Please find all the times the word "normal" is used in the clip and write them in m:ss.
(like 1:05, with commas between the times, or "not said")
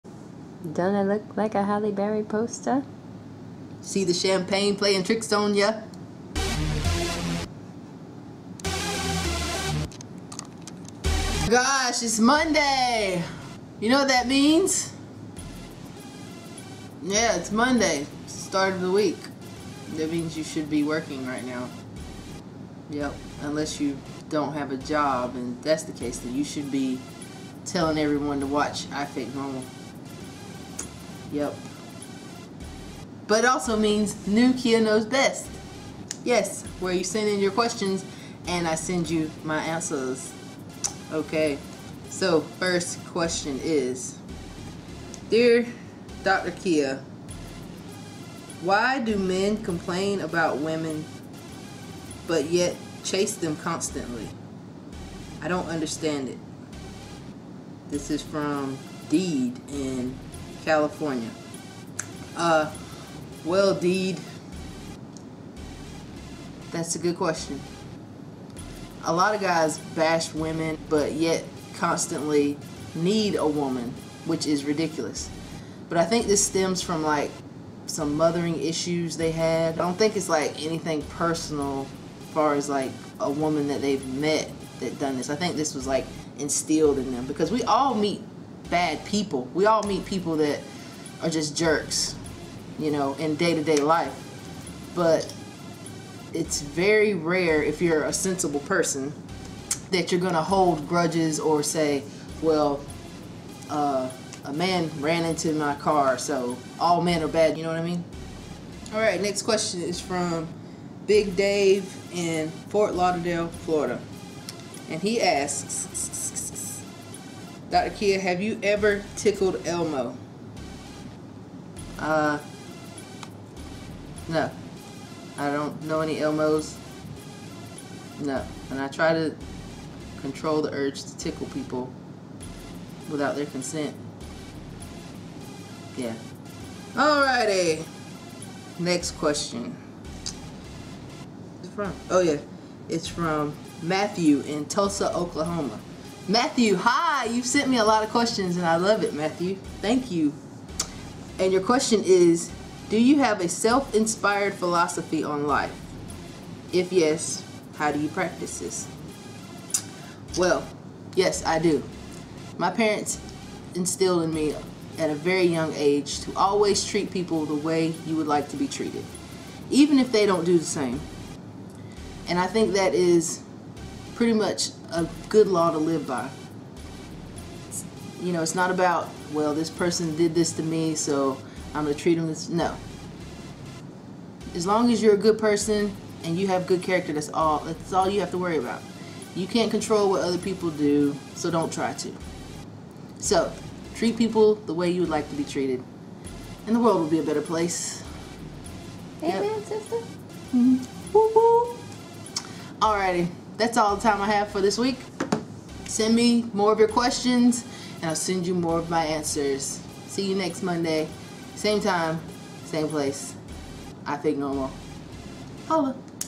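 0:29, 3:34.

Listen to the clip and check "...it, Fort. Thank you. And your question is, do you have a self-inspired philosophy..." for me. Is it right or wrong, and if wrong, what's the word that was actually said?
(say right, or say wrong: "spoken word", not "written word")
wrong: "Matthew", not "Fort".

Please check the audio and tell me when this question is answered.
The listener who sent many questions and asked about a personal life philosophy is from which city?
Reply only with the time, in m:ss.
2:24.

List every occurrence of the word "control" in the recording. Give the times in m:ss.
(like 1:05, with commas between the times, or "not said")
2:10, 3:09.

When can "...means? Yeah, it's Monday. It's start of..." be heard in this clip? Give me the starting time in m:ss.
0:14.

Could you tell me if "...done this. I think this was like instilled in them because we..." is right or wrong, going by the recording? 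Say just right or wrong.
right.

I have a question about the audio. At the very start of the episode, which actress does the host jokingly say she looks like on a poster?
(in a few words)
Halle Berry.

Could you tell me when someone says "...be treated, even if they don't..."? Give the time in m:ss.
2:48.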